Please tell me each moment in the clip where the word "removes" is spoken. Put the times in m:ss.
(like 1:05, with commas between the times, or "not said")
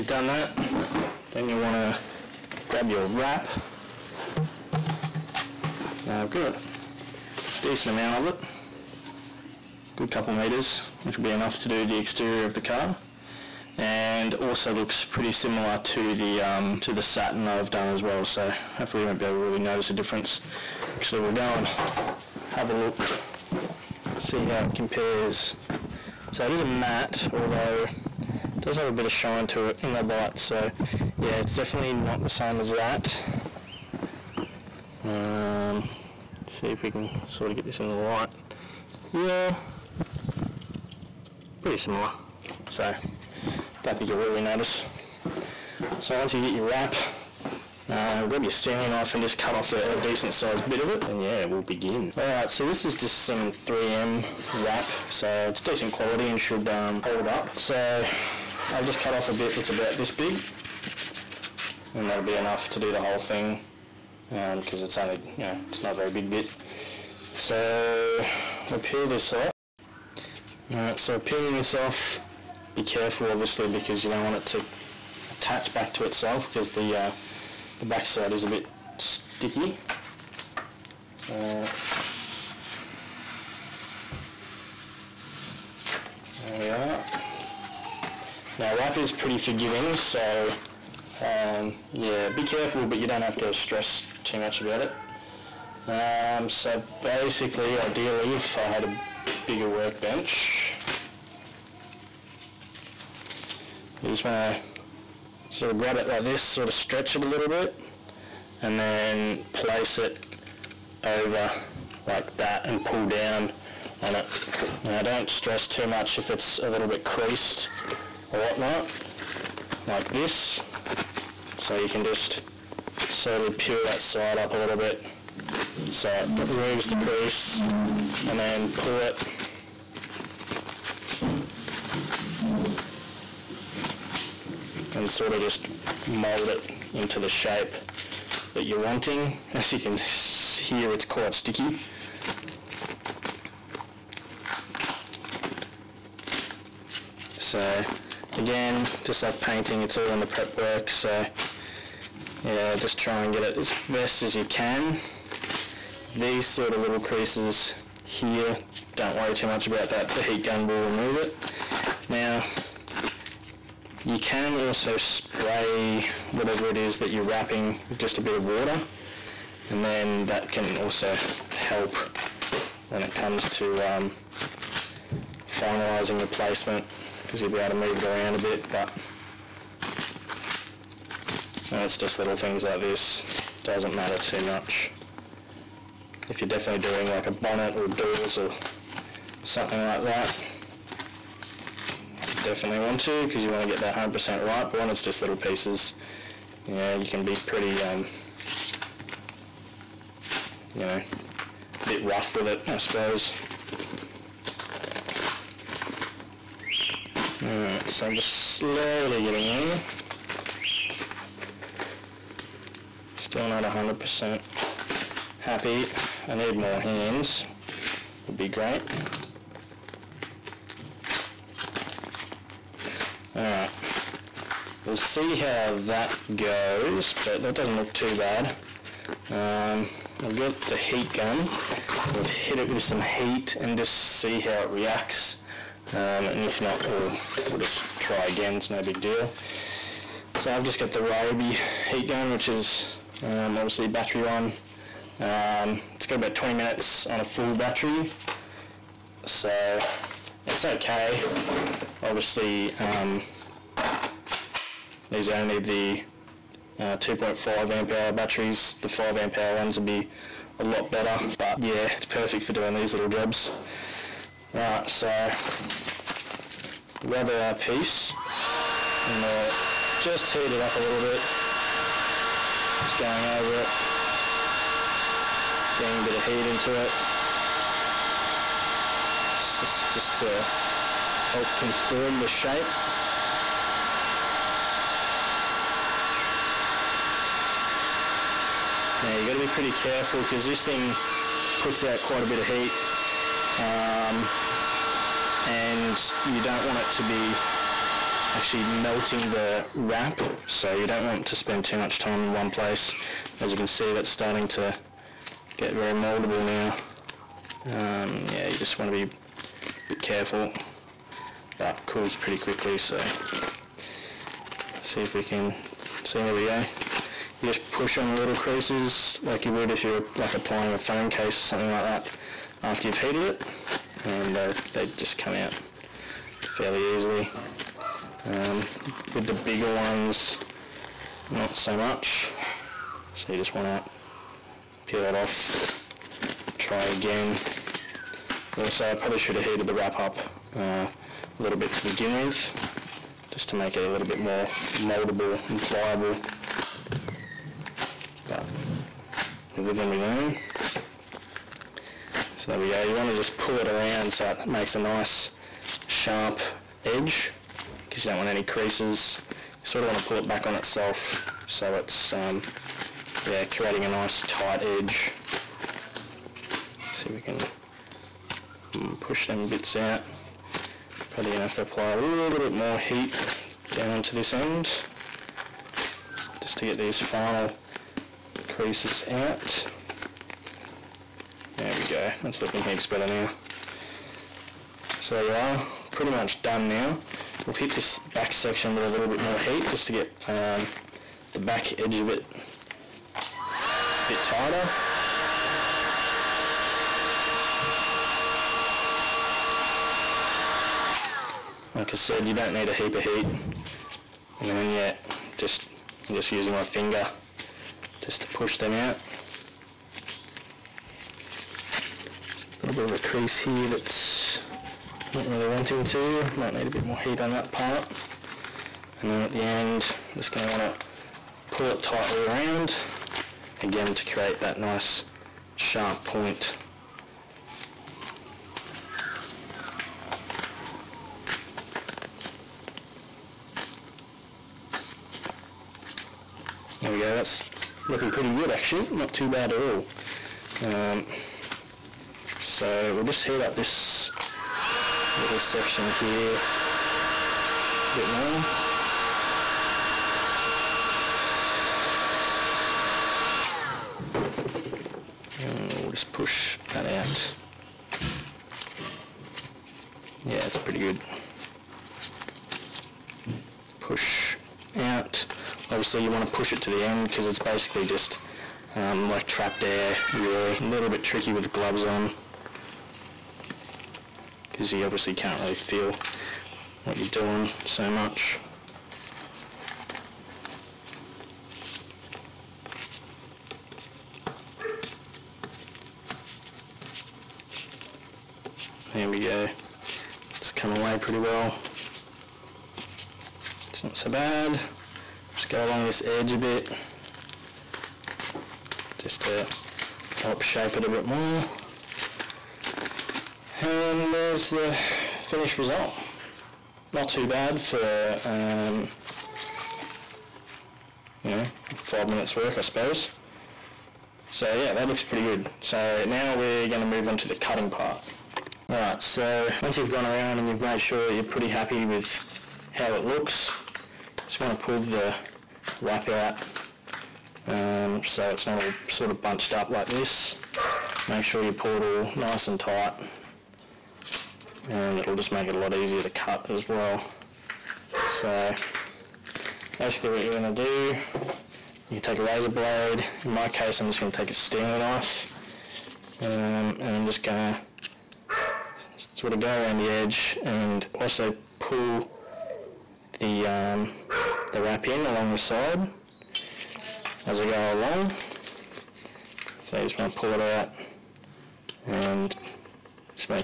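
2:06, 2:40.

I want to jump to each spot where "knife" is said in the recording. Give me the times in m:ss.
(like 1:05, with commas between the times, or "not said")
0:48, 9:04.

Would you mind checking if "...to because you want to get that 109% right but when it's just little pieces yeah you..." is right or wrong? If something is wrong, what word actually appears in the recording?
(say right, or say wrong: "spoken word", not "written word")
wrong: "100", not "109".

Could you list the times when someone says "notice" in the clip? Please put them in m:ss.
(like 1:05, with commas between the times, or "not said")
0:19, 0:44.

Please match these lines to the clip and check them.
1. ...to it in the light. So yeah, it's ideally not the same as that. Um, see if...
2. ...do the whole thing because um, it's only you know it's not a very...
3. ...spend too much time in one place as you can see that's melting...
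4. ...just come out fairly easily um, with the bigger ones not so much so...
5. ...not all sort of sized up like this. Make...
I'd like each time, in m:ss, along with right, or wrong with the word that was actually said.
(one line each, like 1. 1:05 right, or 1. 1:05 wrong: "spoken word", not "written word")
1. 0:29 wrong: "definitely", not "ideally"
2. 1:02 right
3. 5:01 wrong: "starting", not "melting"
4. 5:24 right
5. 8:48 wrong: "bunched", not "sized".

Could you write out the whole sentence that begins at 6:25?
So there you are, pretty much done now.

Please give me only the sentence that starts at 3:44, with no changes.
We'll see how that goes, but that doesn't look too bad.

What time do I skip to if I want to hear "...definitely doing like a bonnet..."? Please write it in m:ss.
3:06.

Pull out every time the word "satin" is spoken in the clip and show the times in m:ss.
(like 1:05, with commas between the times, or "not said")
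0:17.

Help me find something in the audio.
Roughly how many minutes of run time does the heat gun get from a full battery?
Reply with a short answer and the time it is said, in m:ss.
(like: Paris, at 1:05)
20 minutes, at 4:06.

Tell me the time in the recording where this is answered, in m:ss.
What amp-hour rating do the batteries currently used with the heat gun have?
4:16.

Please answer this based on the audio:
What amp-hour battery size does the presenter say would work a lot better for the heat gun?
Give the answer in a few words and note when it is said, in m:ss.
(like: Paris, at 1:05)
5 amp hour, at 4:18.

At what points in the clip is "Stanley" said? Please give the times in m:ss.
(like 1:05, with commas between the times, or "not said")
0:48, 9:04.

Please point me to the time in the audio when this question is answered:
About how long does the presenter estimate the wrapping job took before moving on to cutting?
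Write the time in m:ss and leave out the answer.
8:31.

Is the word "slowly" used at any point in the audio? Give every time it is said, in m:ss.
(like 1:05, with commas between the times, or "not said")
2:03, 3:28.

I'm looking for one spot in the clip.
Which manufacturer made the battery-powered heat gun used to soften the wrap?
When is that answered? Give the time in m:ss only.
4:01.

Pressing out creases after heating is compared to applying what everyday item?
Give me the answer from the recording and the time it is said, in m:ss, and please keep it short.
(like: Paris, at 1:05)
A phone case, at 5:20.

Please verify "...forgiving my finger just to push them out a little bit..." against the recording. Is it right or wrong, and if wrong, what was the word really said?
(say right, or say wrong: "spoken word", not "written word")
wrong: "using", not "forgiving".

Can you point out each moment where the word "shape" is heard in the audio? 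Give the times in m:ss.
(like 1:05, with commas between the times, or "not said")
2:17, 4:42, 8:20.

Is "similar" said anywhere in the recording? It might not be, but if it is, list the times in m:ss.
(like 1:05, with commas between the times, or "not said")
0:15, 0:41.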